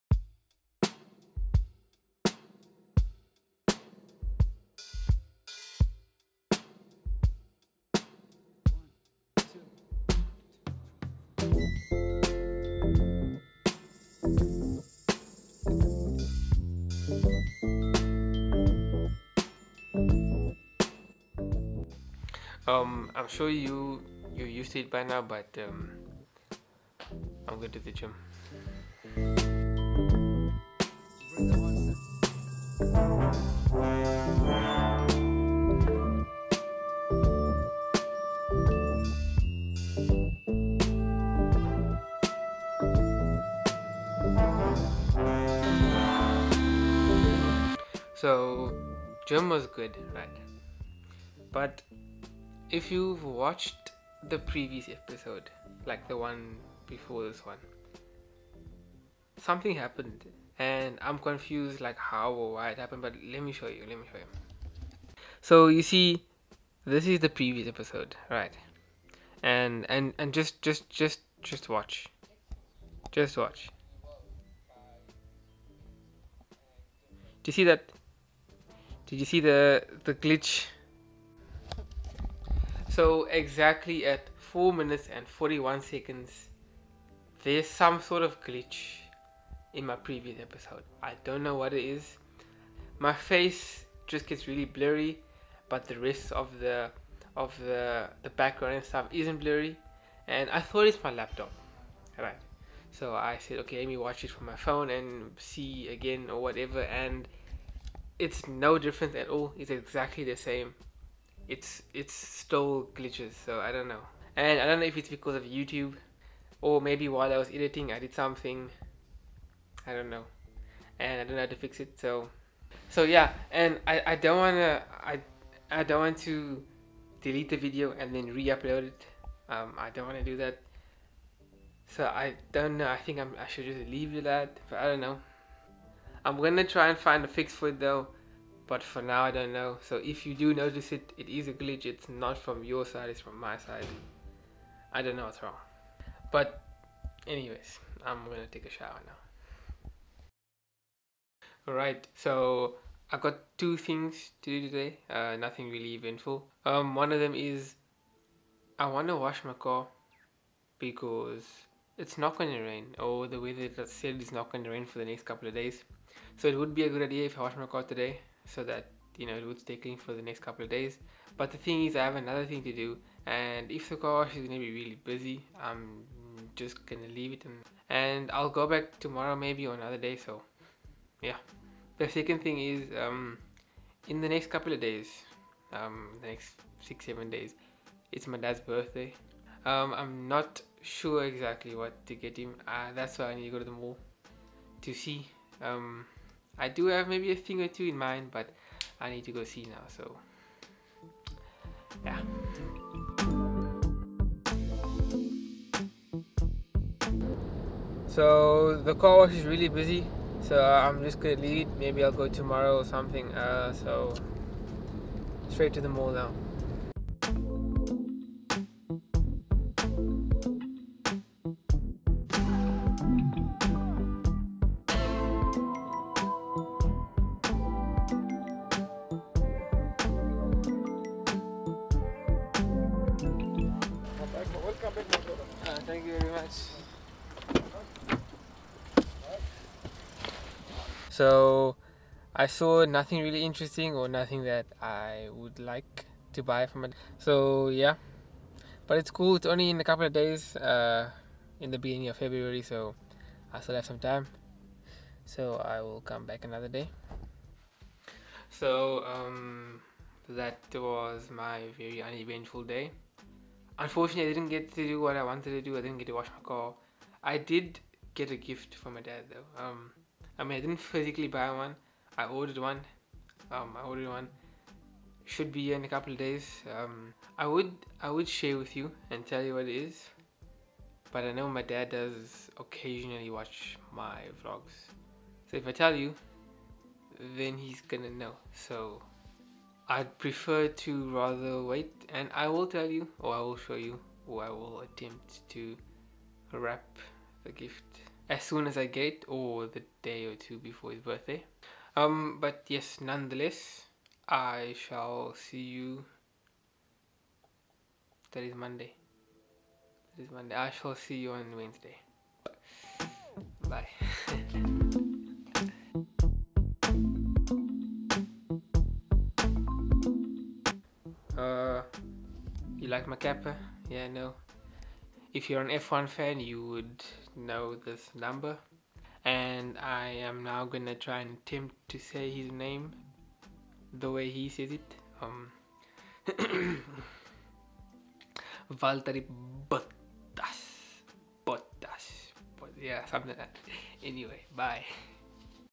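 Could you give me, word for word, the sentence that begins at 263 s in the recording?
Unfortunately, I didn't get to do what I wanted to do.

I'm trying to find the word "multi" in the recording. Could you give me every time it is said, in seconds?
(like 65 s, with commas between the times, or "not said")
not said.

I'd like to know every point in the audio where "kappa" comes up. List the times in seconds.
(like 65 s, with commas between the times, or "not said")
323 s.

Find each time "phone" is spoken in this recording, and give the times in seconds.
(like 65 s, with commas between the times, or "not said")
104 s.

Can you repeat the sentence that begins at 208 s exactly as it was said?
So the car wash is really busy, so I'm just gonna leave.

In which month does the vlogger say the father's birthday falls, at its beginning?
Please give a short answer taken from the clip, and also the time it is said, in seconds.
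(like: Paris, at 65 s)
February, at 252 s.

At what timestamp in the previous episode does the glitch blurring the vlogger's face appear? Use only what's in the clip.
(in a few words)
4 minutes 41 seconds.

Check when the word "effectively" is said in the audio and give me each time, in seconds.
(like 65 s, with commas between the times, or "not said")
not said.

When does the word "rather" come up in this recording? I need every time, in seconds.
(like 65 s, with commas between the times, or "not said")
291 s.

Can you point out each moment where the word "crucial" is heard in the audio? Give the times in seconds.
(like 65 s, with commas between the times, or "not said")
not said.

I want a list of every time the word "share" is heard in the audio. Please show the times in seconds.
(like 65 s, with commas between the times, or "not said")
278 s.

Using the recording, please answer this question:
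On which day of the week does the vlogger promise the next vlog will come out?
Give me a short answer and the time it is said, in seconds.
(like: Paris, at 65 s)
Wednesday, at 311 s.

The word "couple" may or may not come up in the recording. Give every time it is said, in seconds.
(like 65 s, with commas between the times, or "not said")
165 s, 170 s, 184 s, 249 s, 275 s.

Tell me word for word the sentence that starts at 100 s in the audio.
And I thought it's my laptop.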